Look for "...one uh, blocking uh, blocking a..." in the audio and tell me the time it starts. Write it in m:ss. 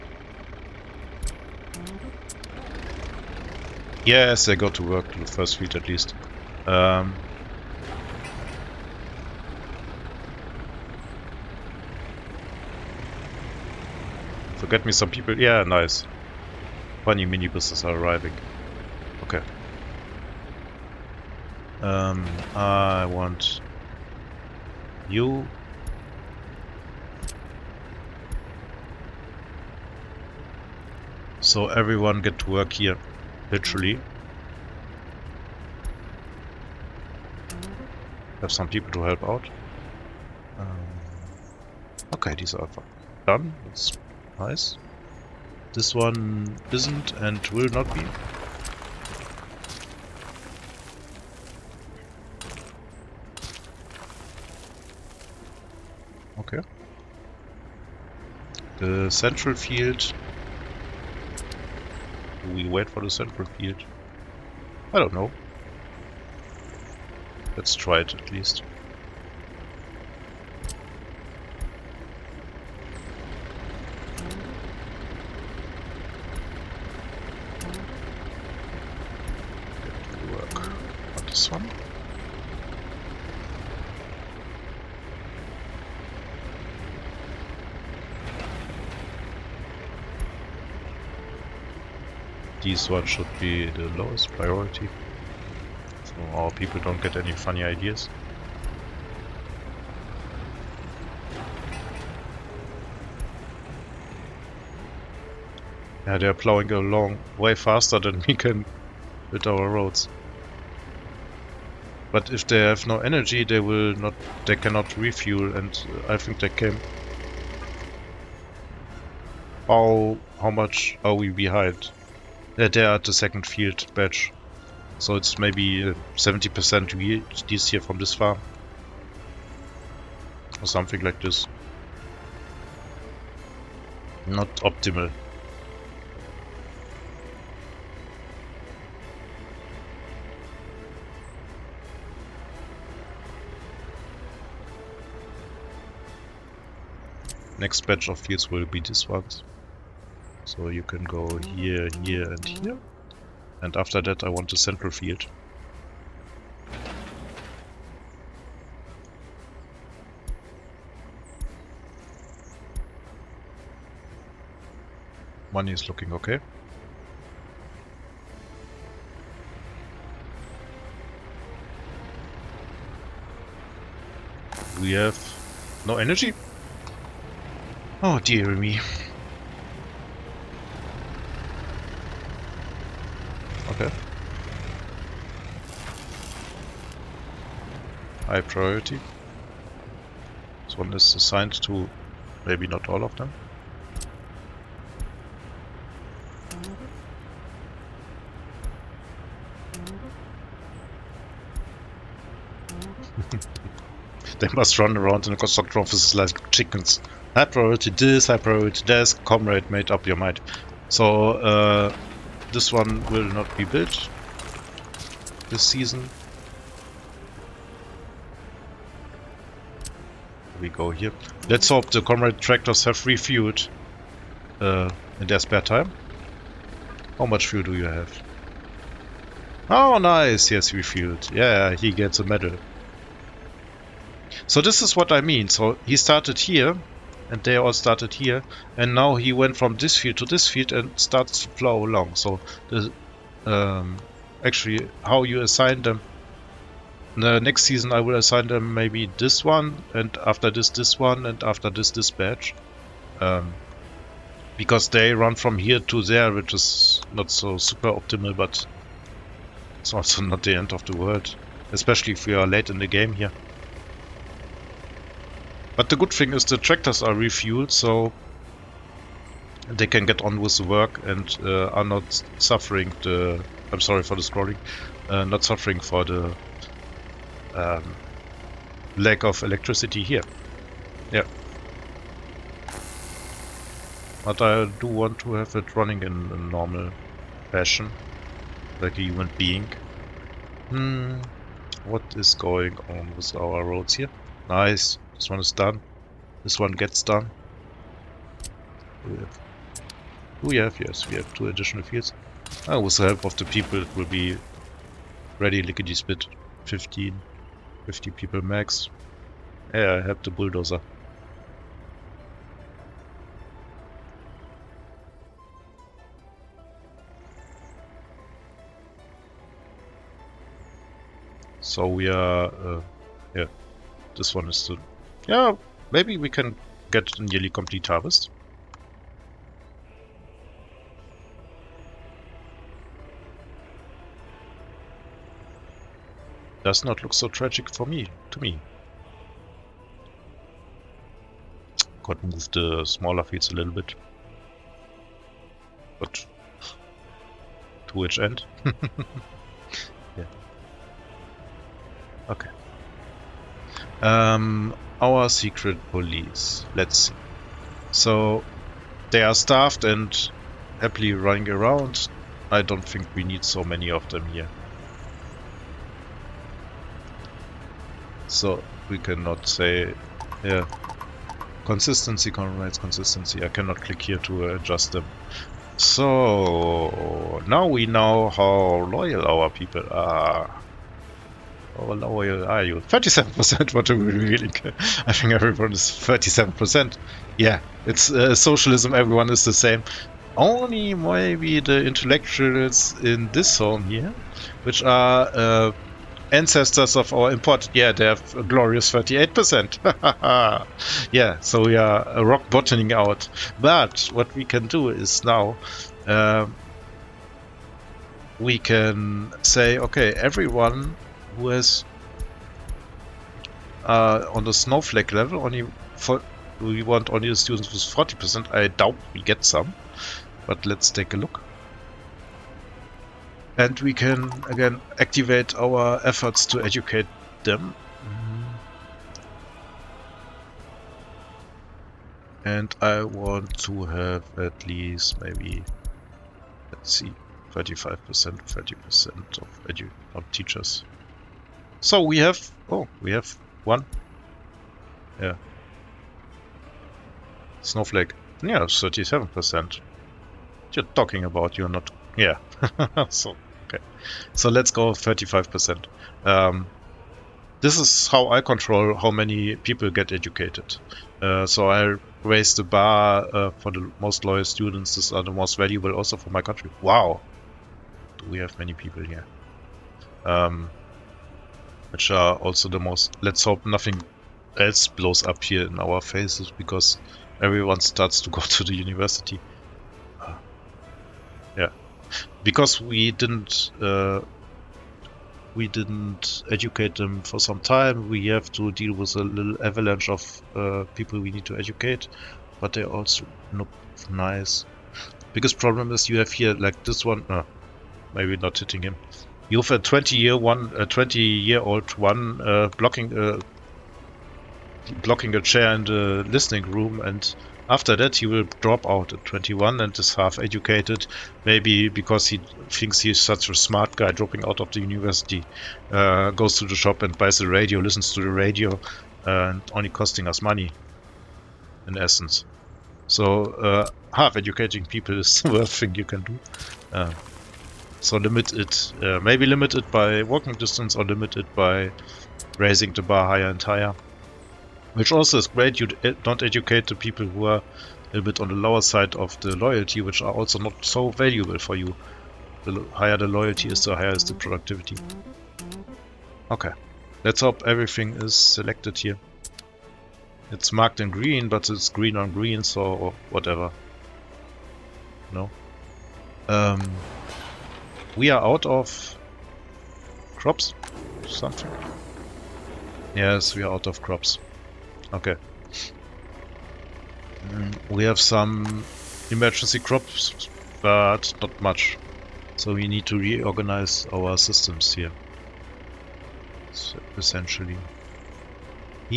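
8:21.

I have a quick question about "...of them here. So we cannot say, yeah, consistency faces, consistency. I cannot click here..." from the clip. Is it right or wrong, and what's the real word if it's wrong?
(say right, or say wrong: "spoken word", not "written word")
wrong: "comrades", not "faces".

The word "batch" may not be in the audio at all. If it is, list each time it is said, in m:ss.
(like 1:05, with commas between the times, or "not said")
2:03, 2:27.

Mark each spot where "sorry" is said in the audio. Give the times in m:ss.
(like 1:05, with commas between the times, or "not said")
4:33.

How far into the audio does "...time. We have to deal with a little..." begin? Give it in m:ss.
8:07.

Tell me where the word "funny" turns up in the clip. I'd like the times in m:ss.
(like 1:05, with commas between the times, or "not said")
0:17, 1:37.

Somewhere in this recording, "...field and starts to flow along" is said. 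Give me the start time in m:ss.
4:00.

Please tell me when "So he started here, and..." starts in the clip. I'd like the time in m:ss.
3:55.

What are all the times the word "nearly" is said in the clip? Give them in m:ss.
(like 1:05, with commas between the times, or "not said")
5:27.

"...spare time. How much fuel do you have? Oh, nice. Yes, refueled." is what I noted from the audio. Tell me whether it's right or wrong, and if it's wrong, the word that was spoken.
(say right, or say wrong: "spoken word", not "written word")
right.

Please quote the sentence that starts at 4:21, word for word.
Especially if we are late in the game here.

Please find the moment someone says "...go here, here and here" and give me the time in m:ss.
2:31.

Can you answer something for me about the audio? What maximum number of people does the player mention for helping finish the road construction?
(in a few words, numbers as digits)
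50.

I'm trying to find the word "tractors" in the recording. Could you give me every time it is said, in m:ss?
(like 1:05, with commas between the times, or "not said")
3:42, 4:26.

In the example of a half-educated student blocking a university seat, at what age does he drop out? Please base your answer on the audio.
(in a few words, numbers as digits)
21.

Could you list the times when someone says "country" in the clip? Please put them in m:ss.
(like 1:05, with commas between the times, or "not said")
7:46.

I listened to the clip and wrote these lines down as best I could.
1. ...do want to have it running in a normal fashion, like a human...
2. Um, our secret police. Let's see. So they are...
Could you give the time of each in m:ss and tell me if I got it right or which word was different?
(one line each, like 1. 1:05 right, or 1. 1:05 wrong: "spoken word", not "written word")
1. 4:44 right
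2. 5:54 right.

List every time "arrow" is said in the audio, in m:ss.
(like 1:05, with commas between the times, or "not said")
not said.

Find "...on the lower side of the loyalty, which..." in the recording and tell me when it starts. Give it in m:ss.
8:58.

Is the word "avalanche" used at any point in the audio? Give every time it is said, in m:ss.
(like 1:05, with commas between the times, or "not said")
8:09.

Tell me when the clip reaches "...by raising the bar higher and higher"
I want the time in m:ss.
8:51.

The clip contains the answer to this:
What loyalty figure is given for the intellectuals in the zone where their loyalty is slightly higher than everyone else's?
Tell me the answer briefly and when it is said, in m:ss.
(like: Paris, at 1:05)
38%, at 6:38.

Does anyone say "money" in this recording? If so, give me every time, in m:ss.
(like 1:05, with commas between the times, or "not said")
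2:45, 8:40.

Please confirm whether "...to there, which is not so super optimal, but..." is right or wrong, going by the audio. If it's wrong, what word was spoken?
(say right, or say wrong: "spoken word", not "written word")
right.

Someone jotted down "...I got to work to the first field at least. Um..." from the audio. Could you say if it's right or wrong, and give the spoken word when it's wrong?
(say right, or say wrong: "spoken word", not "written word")
right.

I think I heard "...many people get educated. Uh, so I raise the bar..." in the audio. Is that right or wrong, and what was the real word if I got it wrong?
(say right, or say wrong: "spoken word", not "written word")
right.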